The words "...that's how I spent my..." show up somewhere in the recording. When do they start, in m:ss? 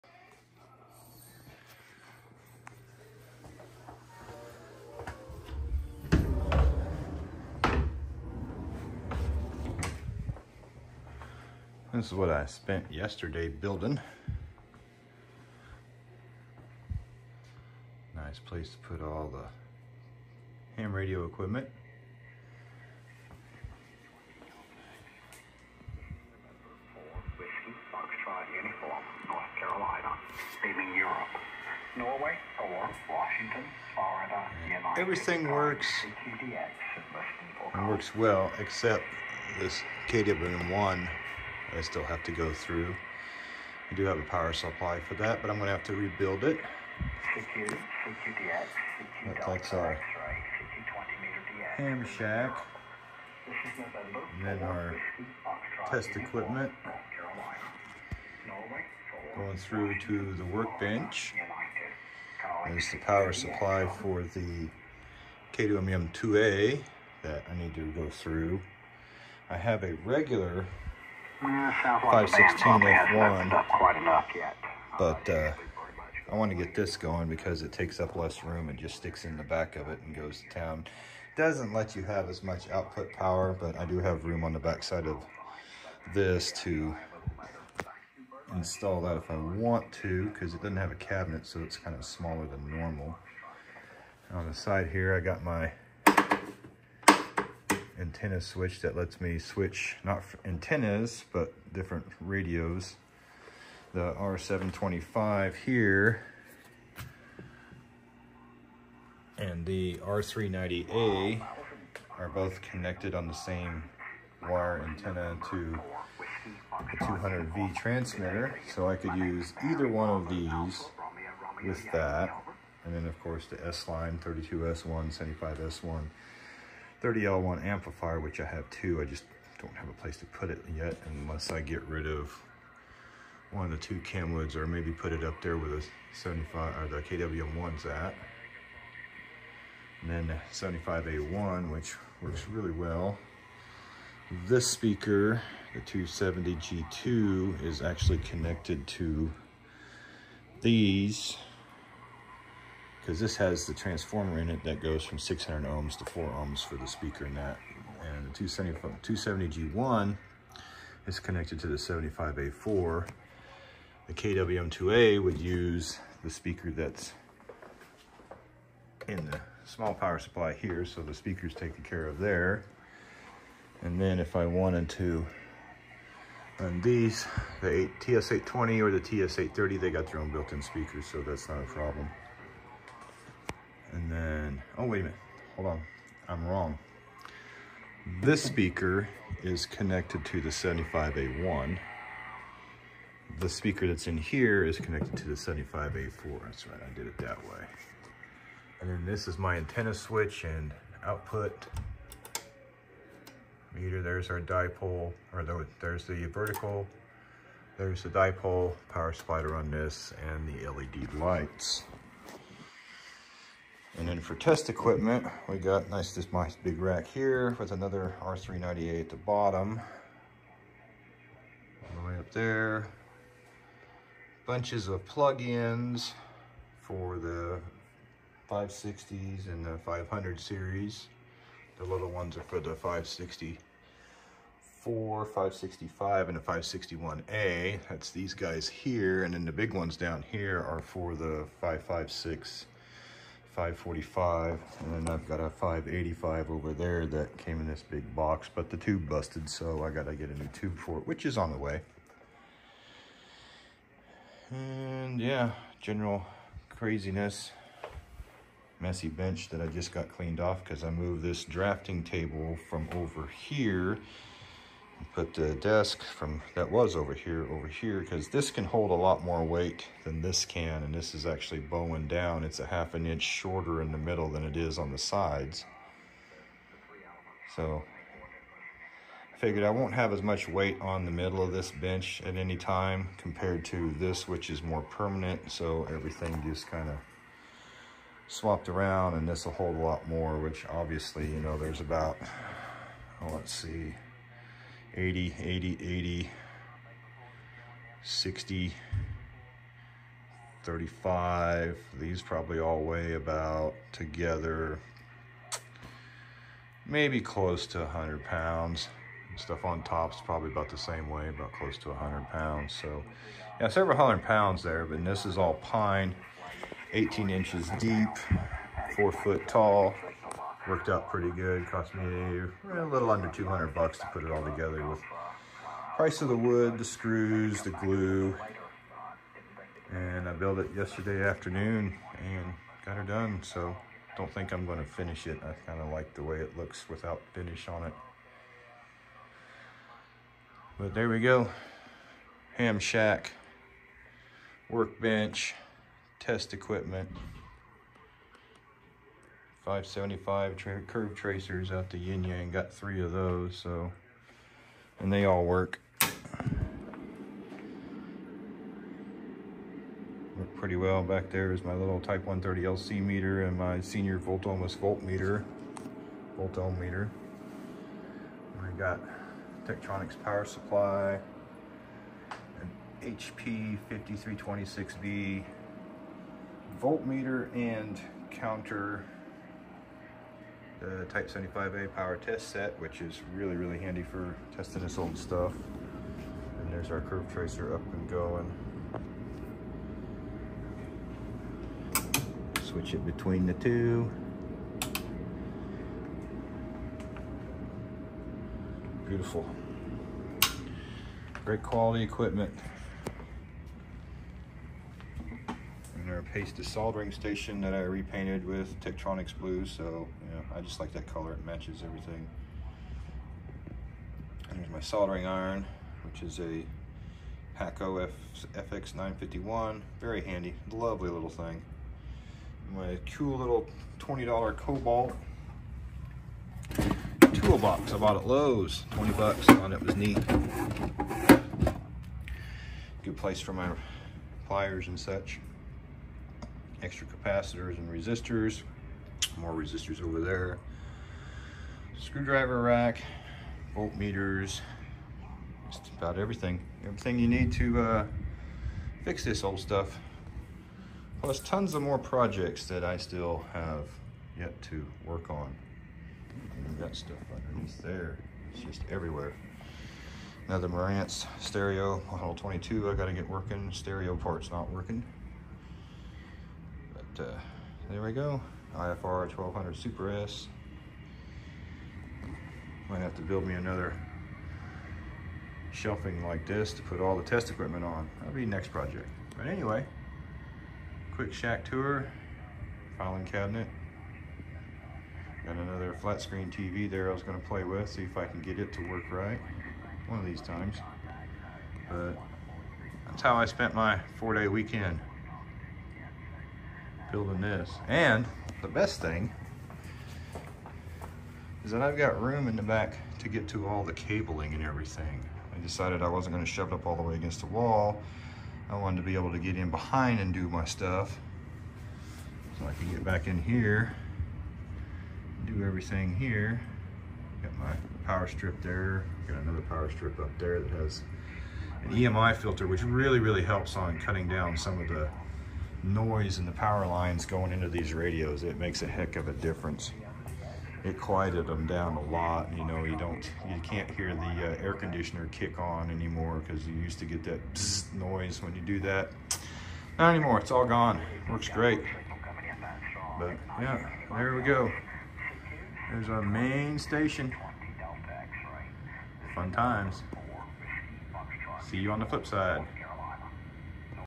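8:13.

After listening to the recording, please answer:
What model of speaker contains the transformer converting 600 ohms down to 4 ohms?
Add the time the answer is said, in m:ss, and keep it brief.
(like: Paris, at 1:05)
270G2, at 2:25.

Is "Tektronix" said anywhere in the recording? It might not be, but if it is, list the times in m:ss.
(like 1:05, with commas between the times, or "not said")
6:09, 6:48.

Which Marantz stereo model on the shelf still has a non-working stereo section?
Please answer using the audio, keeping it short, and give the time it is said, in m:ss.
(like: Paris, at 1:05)
Model 22, at 7:42.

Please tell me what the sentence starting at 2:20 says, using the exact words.
And then 75A1, which works really well.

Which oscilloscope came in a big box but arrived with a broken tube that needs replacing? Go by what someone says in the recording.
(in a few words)
585.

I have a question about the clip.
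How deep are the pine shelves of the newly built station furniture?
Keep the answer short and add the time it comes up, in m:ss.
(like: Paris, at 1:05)
18 inches, at 5:16.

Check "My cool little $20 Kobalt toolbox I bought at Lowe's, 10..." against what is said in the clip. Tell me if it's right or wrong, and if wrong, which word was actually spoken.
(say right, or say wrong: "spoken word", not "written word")
wrong: "20", not "10".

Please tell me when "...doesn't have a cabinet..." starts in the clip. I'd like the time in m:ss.
1:30.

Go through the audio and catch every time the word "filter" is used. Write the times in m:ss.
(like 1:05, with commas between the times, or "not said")
8:42.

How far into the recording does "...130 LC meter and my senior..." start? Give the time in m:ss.
6:02.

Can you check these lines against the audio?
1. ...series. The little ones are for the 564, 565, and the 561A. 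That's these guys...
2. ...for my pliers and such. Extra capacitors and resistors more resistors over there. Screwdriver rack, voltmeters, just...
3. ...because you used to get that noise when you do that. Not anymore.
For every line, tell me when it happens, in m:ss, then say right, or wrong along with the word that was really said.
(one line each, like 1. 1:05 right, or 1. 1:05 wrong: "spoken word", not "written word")
1. 3:50 right
2. 7:13 right
3. 8:56 right.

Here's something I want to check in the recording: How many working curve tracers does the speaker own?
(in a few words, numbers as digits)
3.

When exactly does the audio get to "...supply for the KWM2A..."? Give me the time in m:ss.
1:03.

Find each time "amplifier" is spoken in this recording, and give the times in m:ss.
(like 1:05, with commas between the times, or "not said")
2:07.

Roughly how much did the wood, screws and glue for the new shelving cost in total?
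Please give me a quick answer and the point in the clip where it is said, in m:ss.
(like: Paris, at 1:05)
Under 200 dollars, at 5:22.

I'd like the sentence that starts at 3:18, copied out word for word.
And then this is my antenna switch and output meter.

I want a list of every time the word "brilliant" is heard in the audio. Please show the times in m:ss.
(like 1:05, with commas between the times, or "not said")
not said.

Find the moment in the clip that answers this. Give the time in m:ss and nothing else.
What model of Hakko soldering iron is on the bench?
6:58.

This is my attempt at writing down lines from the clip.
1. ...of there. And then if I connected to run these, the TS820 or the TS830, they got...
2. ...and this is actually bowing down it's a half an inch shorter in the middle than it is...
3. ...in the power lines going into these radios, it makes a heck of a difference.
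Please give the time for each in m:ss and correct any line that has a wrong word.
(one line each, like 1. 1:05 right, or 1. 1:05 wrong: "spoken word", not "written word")
1. 2:52 wrong: "wanted", not "connected"
2. 4:30 right
3. 8:46 right.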